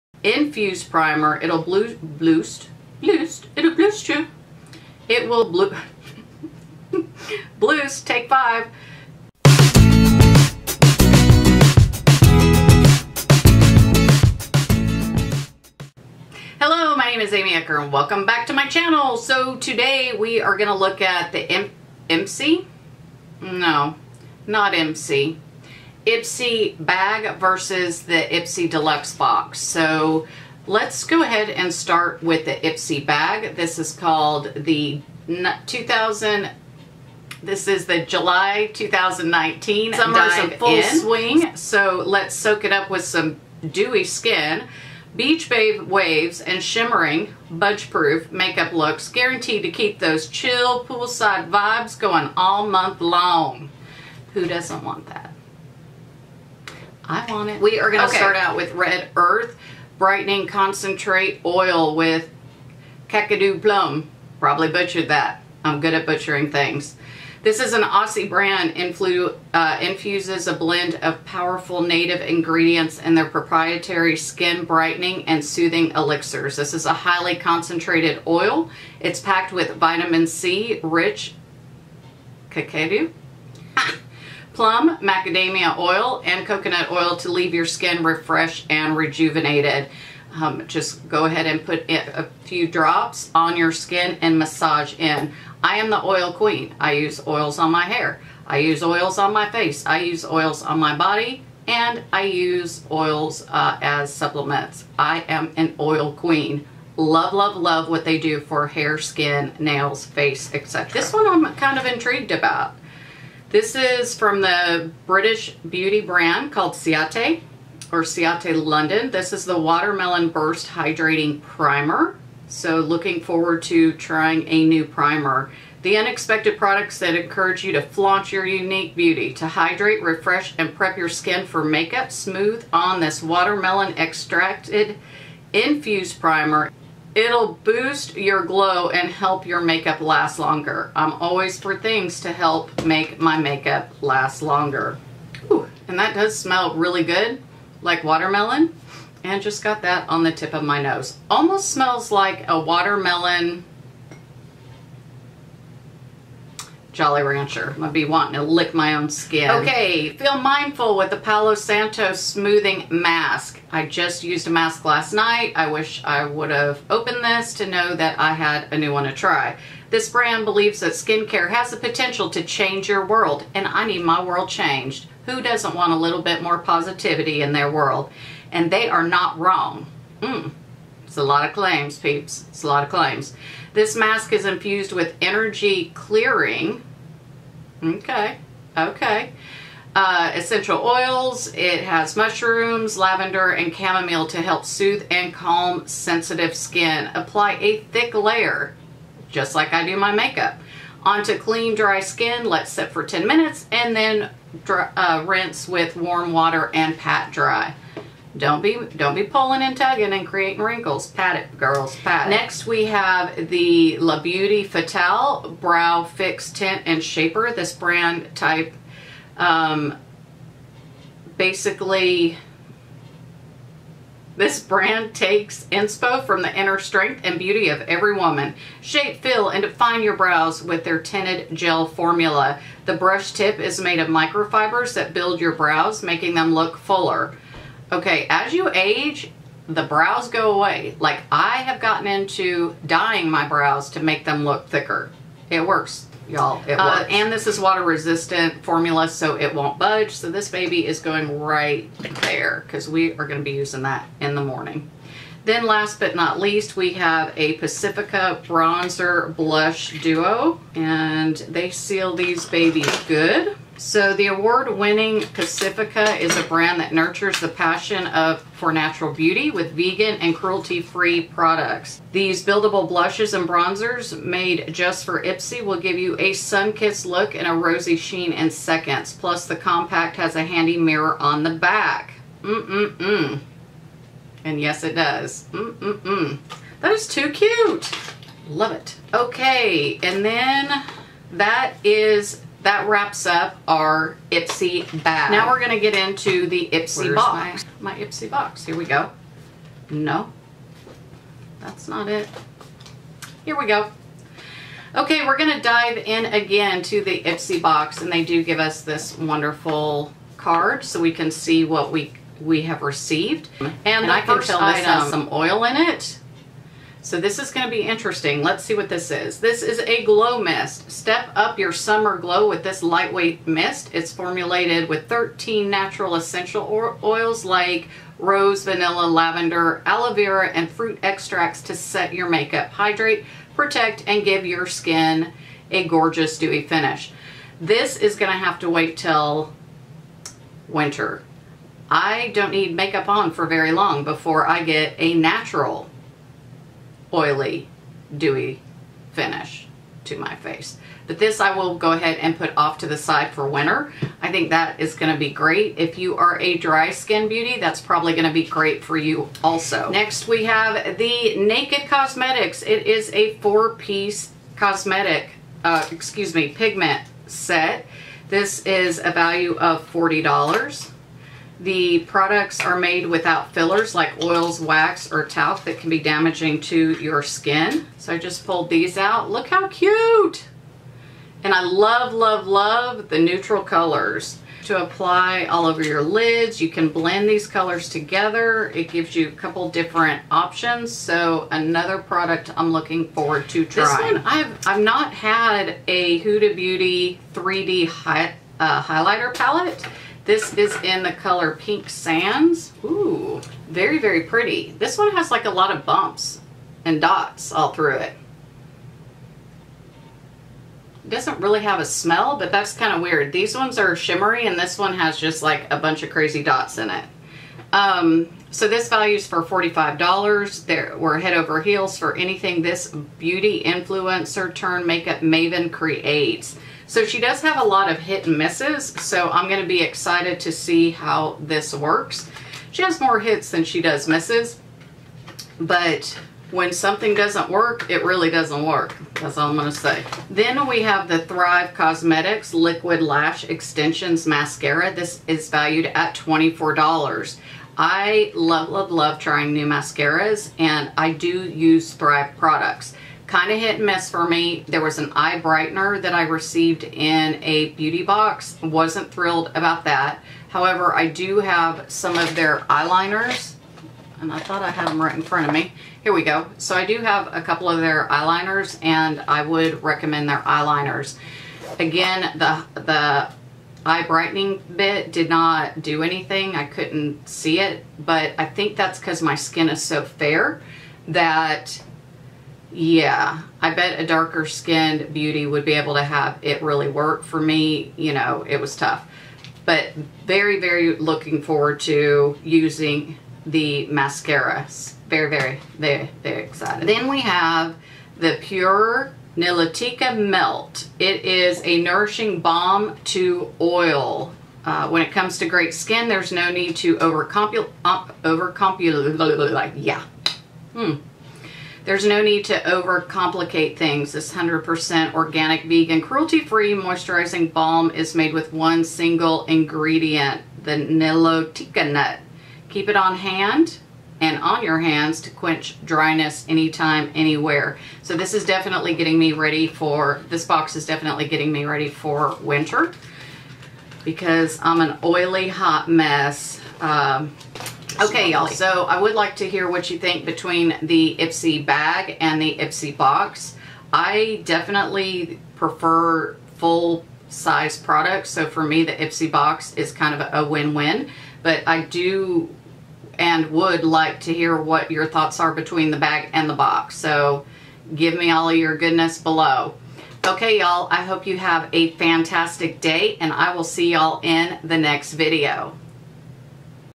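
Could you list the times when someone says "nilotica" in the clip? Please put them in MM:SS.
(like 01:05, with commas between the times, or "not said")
08:19, 08:40.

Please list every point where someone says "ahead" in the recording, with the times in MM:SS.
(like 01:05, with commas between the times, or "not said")
00:31, 01:31, 05:51.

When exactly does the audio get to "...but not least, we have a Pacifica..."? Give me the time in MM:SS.
04:15.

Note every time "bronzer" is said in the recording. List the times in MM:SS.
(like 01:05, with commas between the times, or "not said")
04:18, 04:33.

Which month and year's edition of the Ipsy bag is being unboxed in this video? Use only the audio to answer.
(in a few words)
July 2019.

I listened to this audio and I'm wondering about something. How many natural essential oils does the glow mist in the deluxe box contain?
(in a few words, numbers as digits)
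13.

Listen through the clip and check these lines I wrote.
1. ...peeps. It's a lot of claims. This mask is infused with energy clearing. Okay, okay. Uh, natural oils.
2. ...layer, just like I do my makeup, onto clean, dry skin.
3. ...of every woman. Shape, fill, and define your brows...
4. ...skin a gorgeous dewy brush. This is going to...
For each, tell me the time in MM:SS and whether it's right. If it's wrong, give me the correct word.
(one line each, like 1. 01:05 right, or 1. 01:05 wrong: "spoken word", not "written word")
1. 03:01 wrong: "essential", not "natural"
2. 03:18 right
3. 03:47 right
4. 05:34 wrong: "finish", not "brush".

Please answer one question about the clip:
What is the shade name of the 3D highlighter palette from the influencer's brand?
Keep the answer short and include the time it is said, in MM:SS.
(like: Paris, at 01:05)
Pink Sands, at 06:41.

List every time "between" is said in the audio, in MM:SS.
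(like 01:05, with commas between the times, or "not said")
09:00, 09:15.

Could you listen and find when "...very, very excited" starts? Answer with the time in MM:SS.
08:15.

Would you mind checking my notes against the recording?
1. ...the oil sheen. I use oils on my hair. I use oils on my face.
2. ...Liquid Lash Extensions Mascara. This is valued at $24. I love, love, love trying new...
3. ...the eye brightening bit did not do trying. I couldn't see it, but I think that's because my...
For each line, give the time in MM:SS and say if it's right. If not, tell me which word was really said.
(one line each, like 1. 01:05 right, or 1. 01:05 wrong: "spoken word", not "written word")
1. 01:35 wrong: "queen", not "sheen"
2. 07:22 right
3. 07:52 wrong: "anything", not "trying".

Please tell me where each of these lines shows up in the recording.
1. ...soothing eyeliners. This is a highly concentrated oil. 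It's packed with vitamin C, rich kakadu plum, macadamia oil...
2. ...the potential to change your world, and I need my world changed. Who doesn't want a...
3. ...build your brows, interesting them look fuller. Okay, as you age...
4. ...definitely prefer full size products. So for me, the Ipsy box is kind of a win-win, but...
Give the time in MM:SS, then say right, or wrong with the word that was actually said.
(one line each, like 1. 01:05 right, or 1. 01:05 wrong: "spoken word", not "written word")
1. 01:15 wrong: "elixirs", not "eyeliners"
2. 02:51 right
3. 03:55 wrong: "making", not "interesting"
4. 09:04 right.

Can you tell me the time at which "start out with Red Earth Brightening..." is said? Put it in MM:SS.
00:58.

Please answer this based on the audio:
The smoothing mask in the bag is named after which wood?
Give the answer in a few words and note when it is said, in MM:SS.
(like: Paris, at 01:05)
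Palo Santo, at 02:41.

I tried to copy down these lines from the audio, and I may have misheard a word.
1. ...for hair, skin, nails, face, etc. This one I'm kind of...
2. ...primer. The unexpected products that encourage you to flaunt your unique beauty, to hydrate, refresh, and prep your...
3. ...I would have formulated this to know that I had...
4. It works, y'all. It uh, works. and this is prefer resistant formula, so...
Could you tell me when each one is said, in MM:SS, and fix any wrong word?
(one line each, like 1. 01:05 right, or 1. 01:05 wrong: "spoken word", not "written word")
1. 01:48 right
2. 02:04 right
3. 02:46 wrong: "opened", not "formulated"
4. 04:05 wrong: "water", not "prefer".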